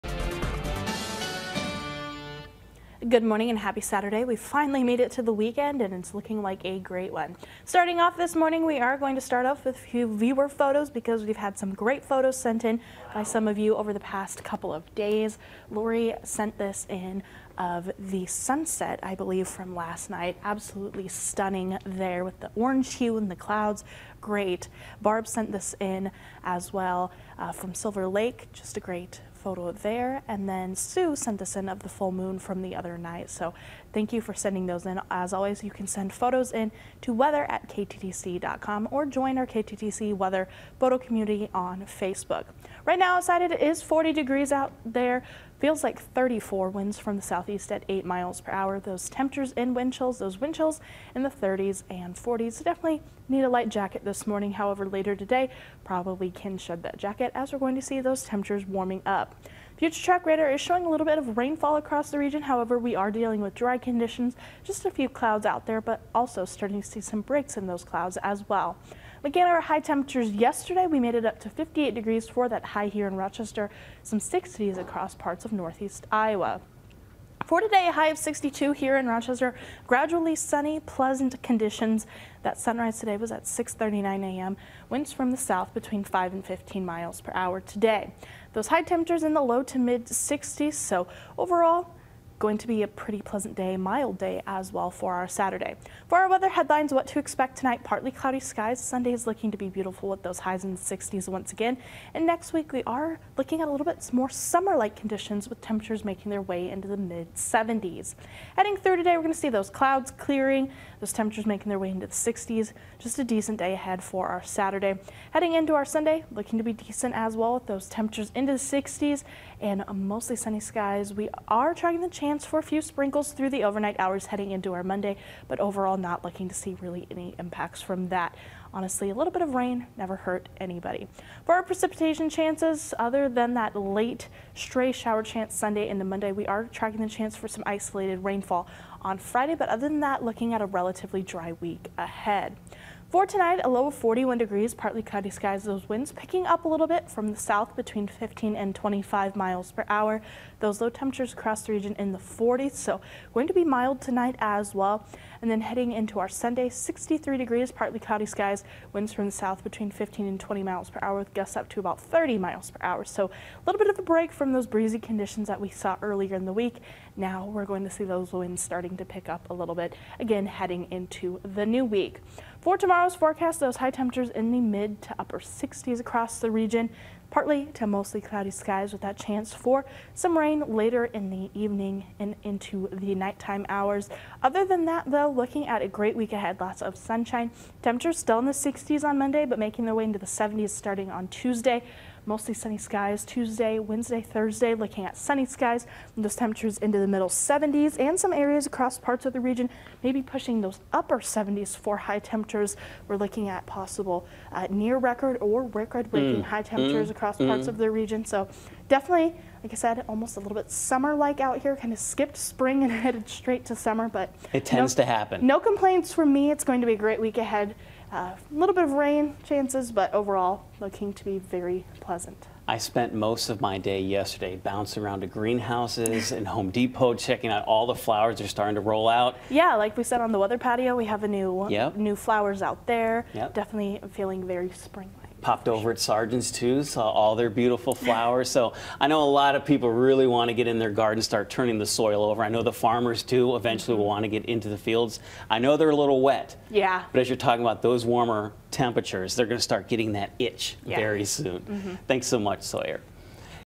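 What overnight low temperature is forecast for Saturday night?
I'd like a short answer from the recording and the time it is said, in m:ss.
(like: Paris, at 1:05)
41 degrees, at 2:23.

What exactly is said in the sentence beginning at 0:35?
As always, you can send photos in to weather at kttc.com or join our KTTC weather photo community on Facebook.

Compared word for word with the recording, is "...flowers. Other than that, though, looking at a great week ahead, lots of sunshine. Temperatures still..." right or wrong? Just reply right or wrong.
wrong.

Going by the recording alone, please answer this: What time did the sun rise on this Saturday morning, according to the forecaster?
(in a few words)
6:39 a.m.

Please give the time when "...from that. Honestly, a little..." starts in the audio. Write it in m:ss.
2:07.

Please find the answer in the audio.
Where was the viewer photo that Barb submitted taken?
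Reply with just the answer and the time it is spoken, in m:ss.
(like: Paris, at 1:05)
Silver Lake, at 0:27.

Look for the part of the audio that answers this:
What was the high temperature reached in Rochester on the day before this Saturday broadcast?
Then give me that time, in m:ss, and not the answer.
1:11.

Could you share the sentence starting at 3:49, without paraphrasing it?
Yeah, like we said on the weather patio, we have a new yep.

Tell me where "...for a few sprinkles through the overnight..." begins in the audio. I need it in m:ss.
2:02.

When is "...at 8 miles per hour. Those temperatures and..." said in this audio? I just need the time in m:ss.
0:47.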